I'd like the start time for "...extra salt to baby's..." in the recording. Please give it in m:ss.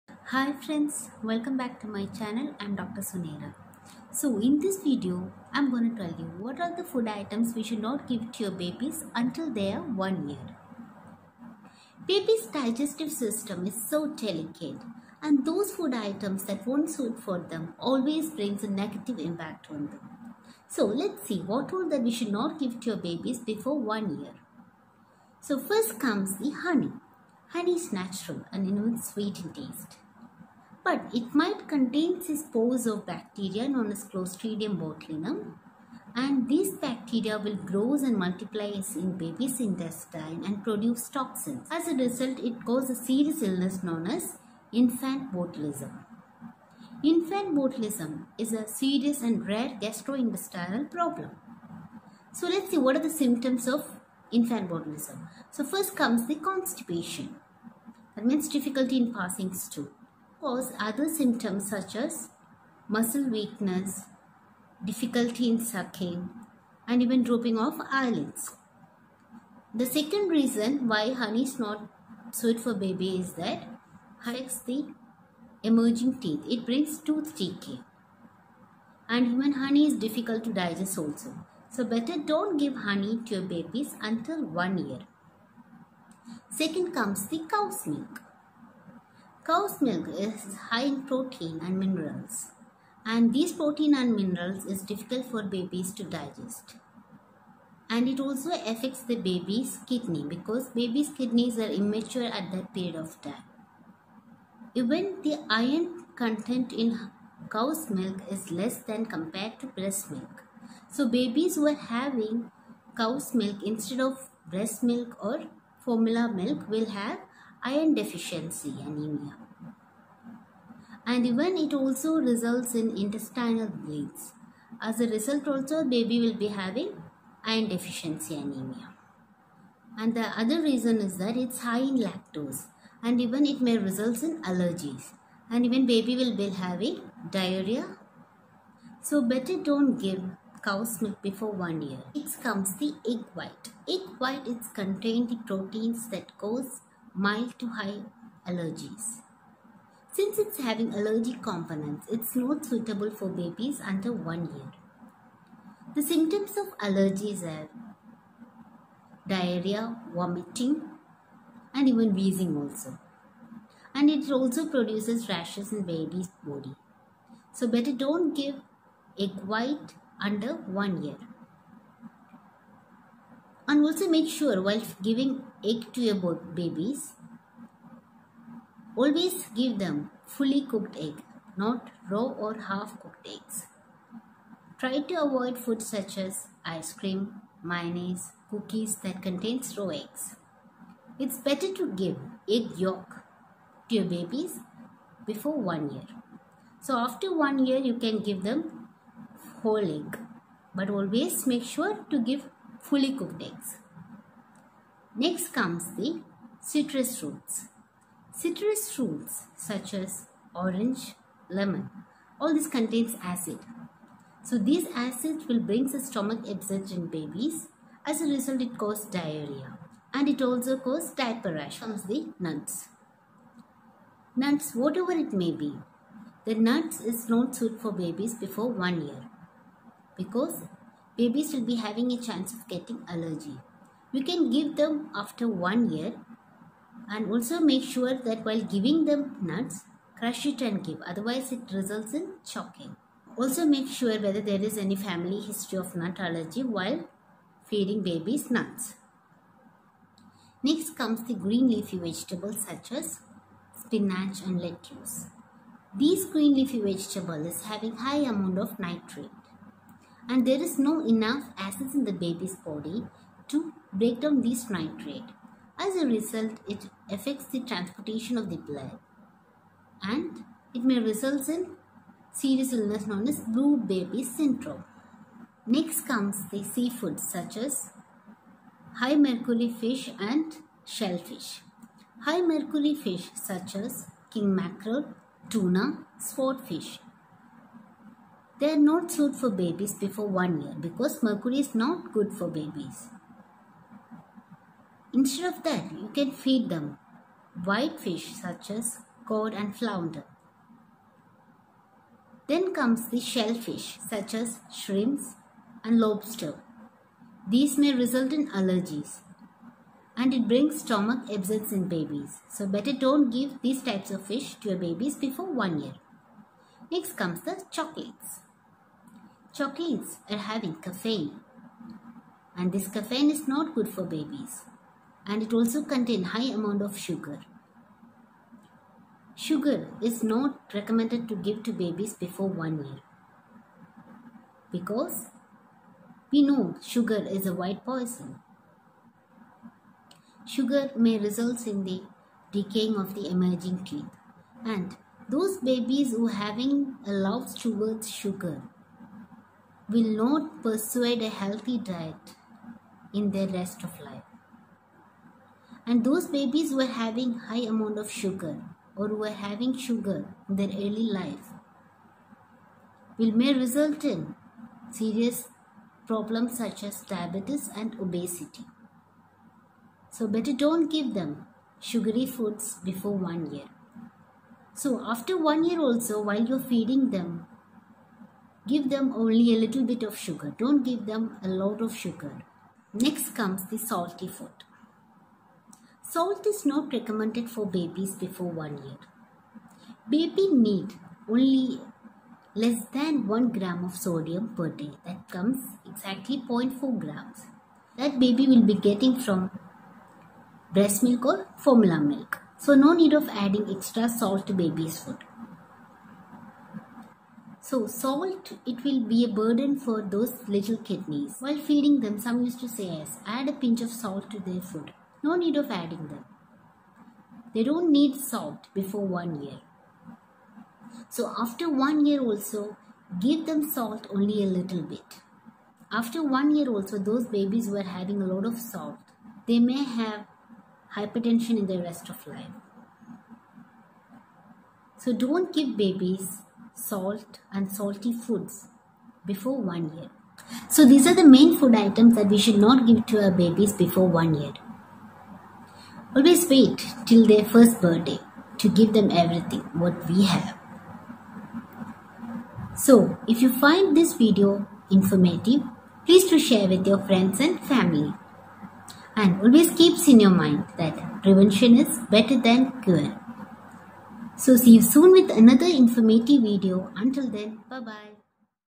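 6:43.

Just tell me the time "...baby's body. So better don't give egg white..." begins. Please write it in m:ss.
2:45.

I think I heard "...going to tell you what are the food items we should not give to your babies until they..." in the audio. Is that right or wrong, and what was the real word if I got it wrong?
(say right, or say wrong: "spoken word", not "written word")
right.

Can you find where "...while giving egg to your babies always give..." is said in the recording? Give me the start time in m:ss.
2:54.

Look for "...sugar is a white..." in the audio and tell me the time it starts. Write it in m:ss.
5:36.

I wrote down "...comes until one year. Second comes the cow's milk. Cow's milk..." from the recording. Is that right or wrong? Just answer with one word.
wrong.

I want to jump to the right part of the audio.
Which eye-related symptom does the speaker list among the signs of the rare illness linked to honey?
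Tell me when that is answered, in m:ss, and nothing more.
1:07.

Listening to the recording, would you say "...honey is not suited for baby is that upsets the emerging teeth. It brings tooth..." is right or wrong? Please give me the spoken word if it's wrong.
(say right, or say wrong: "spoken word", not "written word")
wrong: "hurts", not "upsets".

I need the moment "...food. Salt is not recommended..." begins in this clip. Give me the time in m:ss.
6:24.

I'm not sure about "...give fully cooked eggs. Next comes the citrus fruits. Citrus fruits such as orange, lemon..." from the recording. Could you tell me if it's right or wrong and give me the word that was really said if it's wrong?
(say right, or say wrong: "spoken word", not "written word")
right.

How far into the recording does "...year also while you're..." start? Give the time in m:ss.
6:15.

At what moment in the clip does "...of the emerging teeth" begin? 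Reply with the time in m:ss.
5:42.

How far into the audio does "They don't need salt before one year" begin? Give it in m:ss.
6:57.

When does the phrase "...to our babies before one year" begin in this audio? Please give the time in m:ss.
7:23.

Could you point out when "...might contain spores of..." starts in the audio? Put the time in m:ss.
0:31.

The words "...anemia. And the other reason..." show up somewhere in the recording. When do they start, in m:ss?
2:08.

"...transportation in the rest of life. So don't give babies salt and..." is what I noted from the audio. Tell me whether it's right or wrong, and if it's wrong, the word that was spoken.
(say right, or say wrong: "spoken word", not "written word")
wrong: "hypertension", not "transportation".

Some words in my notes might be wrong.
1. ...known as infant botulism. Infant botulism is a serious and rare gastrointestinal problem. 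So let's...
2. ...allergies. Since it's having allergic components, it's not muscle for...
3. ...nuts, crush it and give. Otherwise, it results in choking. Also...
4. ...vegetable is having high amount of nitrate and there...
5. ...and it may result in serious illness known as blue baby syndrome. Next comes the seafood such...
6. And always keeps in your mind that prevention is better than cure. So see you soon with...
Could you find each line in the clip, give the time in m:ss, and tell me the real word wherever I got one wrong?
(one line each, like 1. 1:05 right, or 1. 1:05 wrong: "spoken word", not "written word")
1. 0:43 right
2. 2:28 wrong: "suitable", not "muscle"
3. 3:59 right
4. 4:16 right
5. 4:30 right
6. 7:39 right.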